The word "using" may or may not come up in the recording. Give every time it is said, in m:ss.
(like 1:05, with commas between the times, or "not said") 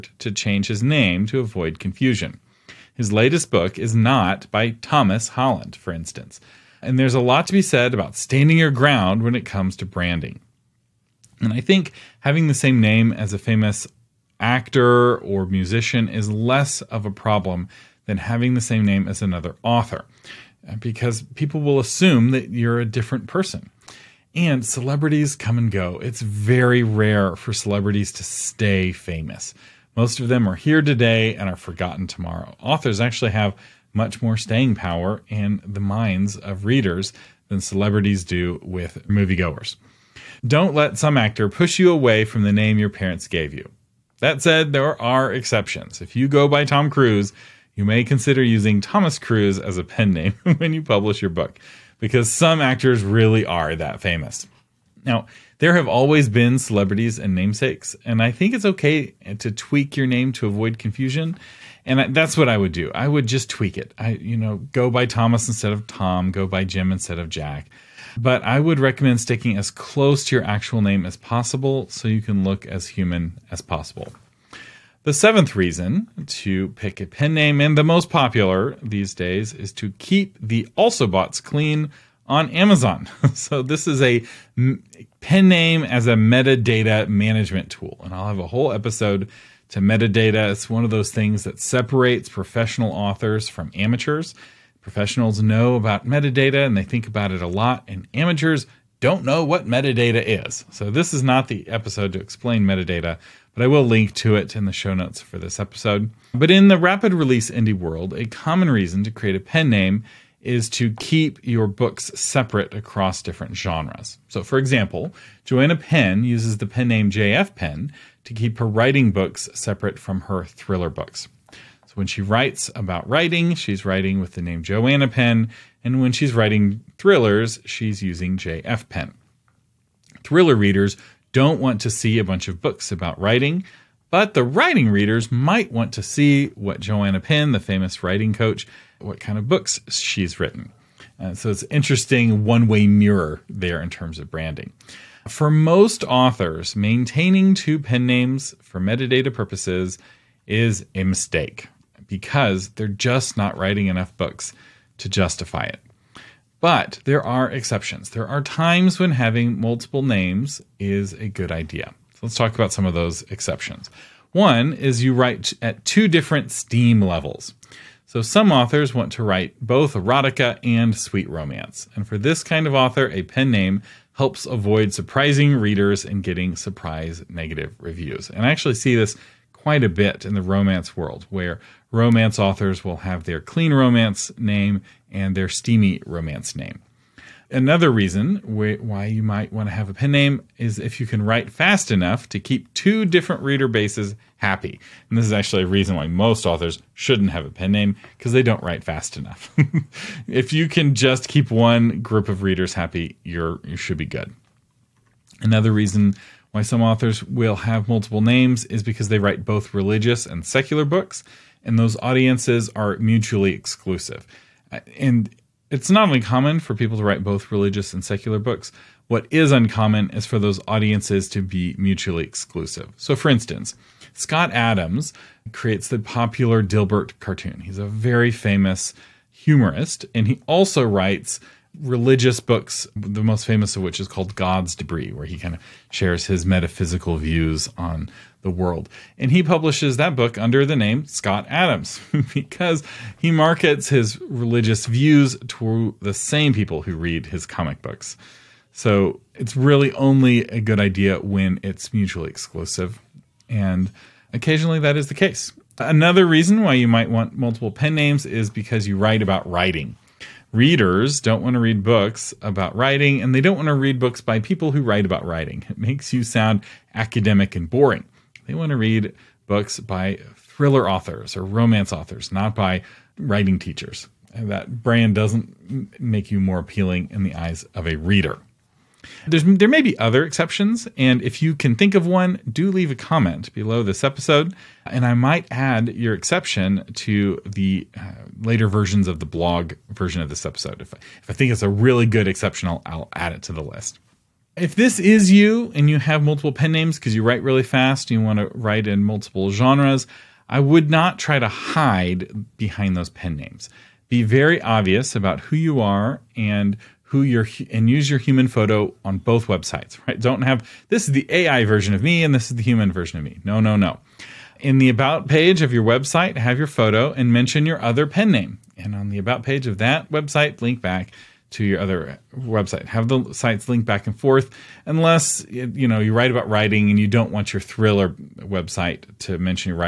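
0:48, 2:08.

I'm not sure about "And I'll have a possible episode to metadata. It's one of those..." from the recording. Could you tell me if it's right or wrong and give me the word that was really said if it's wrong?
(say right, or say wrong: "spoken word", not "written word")
wrong: "whole", not "possible".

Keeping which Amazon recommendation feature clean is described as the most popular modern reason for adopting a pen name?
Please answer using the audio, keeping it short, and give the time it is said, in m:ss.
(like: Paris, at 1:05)
Also boughts, at 1:20.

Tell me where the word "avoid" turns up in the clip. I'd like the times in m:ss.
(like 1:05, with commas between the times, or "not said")
0:01, 1:00, 2:54.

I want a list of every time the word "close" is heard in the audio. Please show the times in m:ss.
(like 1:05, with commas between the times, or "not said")
1:09.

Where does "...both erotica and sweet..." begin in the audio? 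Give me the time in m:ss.
2:49.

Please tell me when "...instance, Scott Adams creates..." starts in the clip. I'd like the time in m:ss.
3:43.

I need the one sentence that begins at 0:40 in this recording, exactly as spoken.
Don't let some actor push you away from the name your parents gave you.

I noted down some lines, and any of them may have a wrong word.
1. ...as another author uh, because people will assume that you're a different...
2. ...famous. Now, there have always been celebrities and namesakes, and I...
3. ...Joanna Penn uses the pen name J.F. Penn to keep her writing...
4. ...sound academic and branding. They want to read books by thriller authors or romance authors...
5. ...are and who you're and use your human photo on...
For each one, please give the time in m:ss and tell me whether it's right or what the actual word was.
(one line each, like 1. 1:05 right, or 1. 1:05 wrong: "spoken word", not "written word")
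1. 0:19 right
2. 0:54 right
3. 1:55 right
4. 4:26 wrong: "boring", not "branding"
5. 5:05 right.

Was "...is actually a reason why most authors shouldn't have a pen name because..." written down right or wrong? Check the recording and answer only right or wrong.
right.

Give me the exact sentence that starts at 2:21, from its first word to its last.
Uh, so it's interesting one way mirror there in terms of branding.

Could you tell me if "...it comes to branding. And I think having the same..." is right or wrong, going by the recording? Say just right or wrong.
right.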